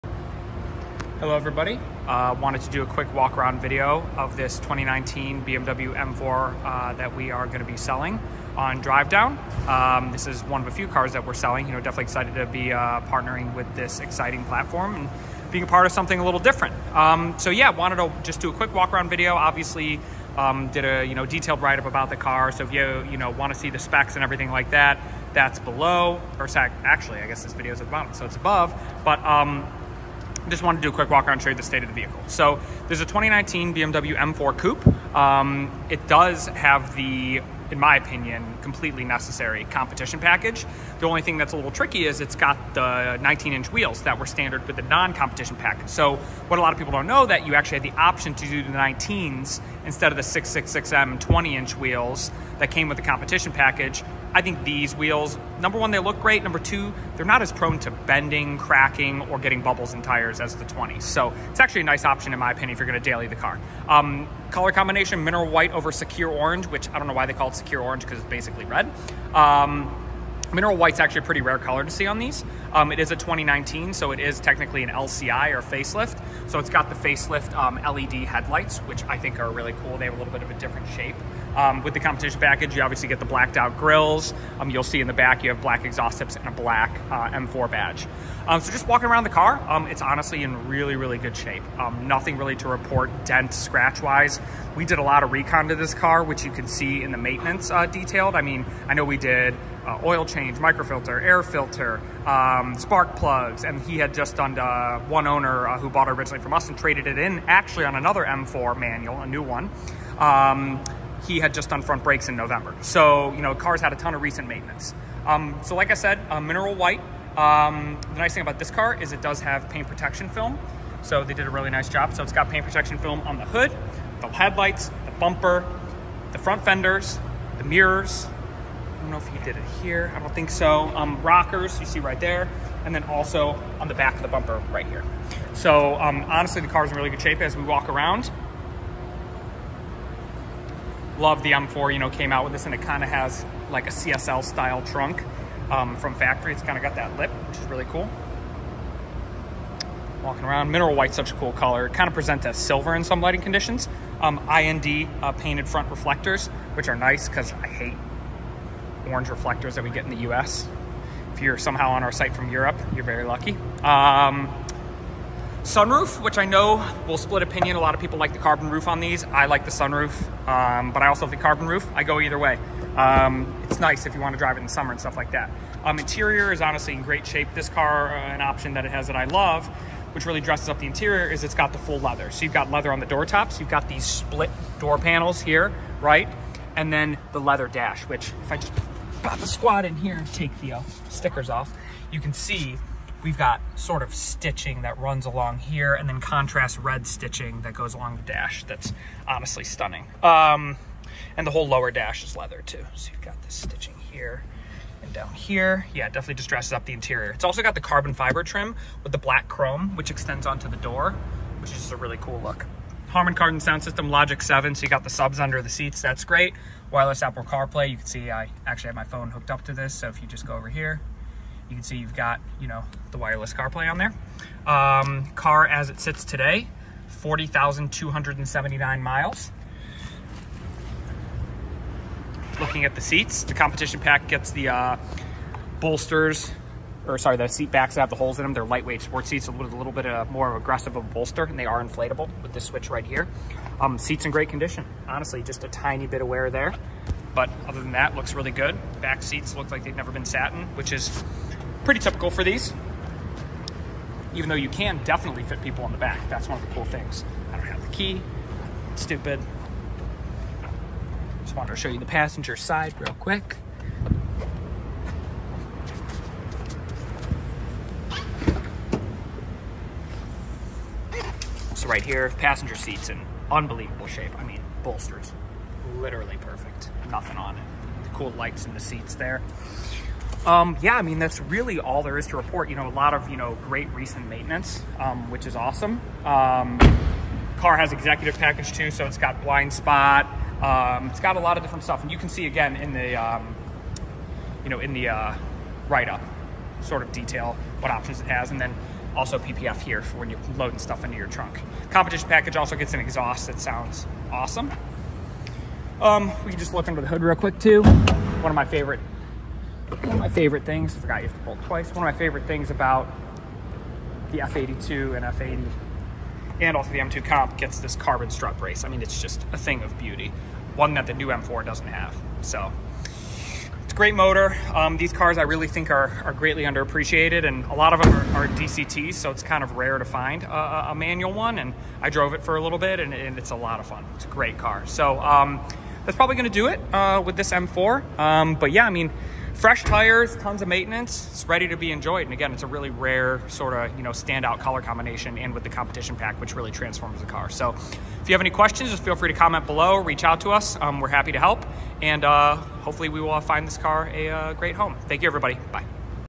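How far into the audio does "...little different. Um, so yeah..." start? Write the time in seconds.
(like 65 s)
16 s.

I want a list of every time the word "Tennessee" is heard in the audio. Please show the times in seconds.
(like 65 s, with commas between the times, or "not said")
not said.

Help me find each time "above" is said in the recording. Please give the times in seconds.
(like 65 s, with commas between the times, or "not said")
28 s.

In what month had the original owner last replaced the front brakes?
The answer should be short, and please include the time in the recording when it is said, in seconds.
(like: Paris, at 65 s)
November, at 112 s.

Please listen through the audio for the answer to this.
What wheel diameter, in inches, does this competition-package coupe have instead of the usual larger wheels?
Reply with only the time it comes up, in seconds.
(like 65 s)
43 s.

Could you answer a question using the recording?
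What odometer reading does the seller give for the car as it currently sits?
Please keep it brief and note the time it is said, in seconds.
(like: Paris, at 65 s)
40,279 miles, at 227 s.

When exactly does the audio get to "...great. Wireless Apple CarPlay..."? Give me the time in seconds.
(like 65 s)
216 s.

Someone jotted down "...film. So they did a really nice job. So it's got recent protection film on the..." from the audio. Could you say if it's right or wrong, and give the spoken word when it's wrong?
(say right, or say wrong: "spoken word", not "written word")
wrong: "paint", not "recent".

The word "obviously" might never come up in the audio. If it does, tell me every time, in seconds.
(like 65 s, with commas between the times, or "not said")
19 s, 82 s.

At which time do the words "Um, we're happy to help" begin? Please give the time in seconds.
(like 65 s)
350 s.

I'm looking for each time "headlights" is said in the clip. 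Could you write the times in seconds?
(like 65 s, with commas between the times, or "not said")
78 s, 124 s.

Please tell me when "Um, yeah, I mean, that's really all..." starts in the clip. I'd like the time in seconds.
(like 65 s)
280 s.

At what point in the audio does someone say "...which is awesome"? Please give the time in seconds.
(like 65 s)
285 s.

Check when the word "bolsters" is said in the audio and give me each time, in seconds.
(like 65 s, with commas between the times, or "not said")
235 s, 241 s, 274 s.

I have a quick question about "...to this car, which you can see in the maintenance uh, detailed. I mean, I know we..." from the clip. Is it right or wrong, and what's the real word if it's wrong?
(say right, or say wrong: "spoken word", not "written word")
right.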